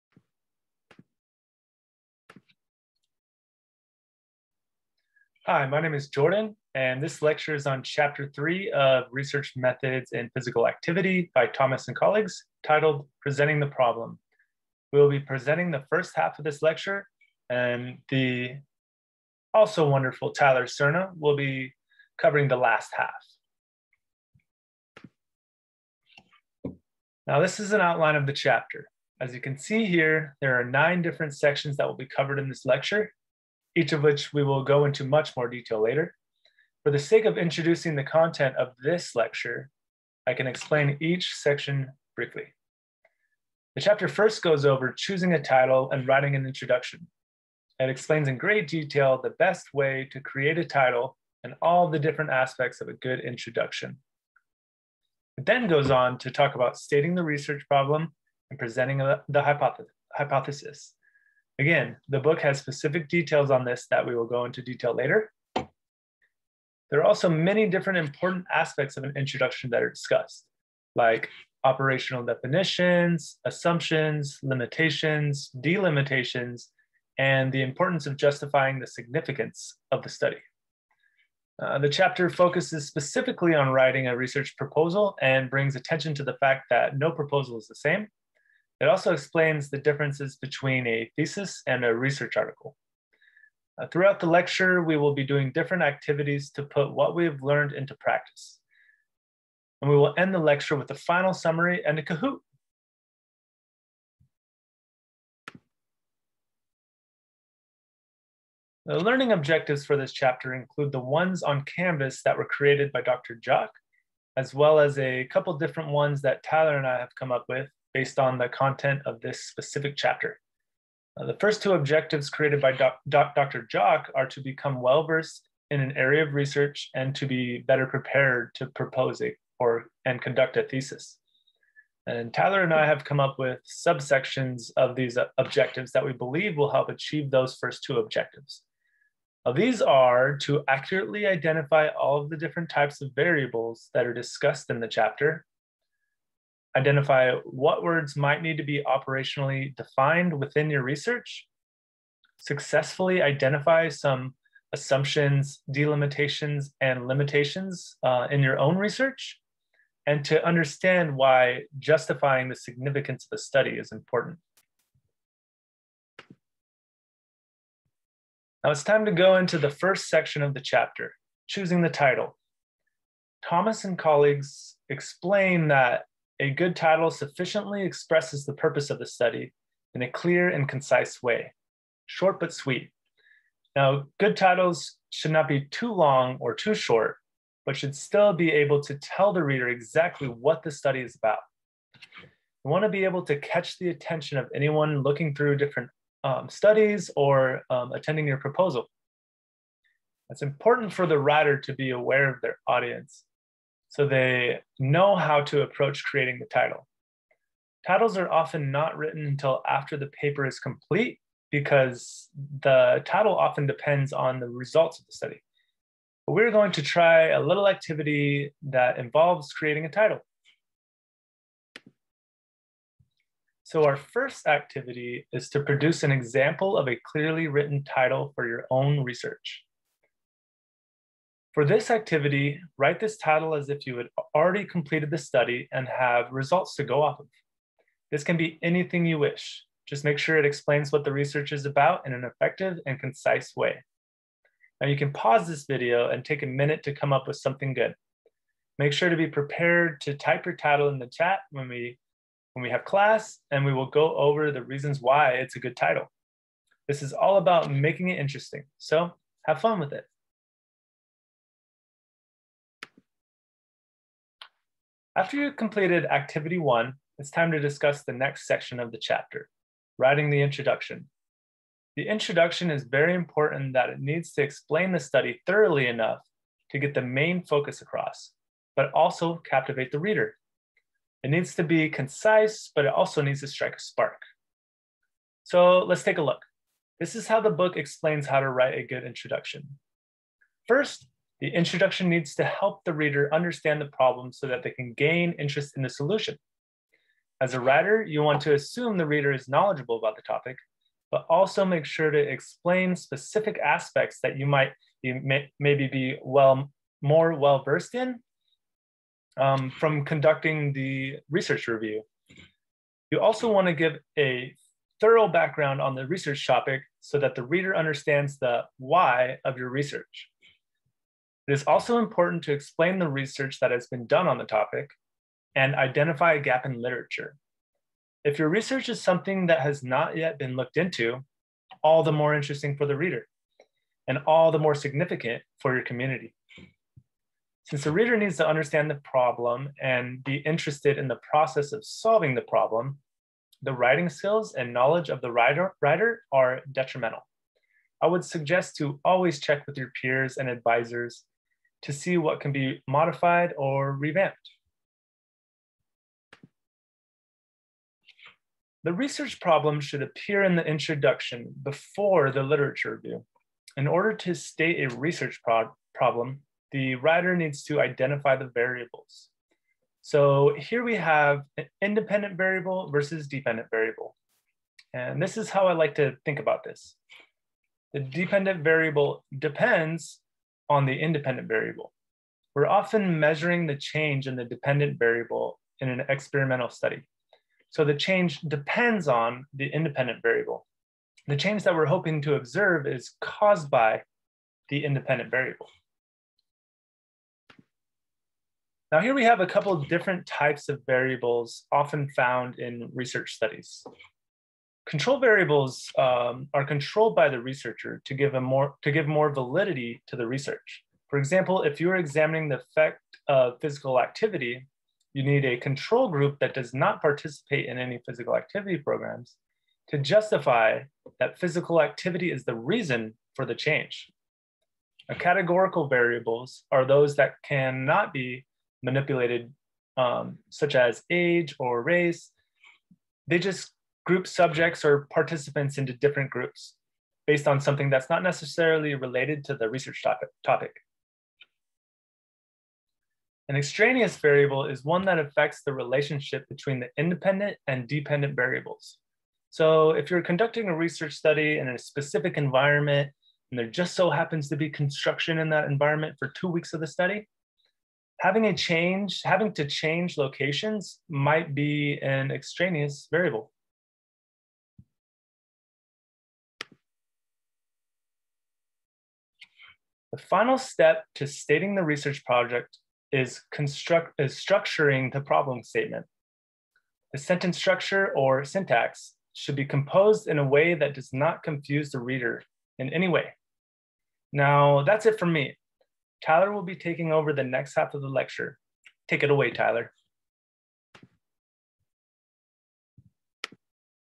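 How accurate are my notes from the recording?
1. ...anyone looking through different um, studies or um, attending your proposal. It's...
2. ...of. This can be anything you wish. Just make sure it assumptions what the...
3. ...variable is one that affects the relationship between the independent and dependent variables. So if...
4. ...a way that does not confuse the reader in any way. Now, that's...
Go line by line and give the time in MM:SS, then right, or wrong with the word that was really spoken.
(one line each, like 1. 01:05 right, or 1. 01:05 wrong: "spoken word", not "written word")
1. 03:14 right
2. 03:57 wrong: "explains", not "assumptions"
3. 07:24 right
4. 08:00 right.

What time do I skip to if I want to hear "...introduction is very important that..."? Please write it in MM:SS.
04:32.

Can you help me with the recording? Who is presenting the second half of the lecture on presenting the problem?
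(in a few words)
Tyler Cerna.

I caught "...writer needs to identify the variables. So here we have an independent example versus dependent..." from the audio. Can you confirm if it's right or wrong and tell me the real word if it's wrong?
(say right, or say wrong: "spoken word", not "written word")
wrong: "variable", not "example".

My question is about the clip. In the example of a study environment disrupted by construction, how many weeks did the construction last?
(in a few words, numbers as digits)
2.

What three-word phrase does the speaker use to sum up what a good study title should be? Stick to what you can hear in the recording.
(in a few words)
short but sweet.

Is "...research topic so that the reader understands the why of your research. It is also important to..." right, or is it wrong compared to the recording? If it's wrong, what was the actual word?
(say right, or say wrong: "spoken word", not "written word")
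right.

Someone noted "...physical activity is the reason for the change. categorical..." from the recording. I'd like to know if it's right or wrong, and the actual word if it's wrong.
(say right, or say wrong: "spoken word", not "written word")
right.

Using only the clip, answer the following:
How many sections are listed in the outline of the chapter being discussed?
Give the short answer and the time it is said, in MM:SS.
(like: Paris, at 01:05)
9, at 00:30.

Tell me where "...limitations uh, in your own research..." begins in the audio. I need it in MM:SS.
02:37.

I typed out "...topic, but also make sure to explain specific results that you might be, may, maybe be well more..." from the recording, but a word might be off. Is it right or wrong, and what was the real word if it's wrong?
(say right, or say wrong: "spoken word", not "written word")
wrong: "aspects", not "results".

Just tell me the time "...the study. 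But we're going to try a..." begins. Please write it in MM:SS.
03:35.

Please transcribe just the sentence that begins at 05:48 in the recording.
I would suggest to always check with your peers and advisors to see what can be modified or revamped.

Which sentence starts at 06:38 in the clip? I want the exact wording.
Now here we have a couple different types of variables often found in research studies.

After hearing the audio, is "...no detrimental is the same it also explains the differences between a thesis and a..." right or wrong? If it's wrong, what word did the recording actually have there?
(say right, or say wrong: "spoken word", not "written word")
wrong: "proposal", not "detrimental".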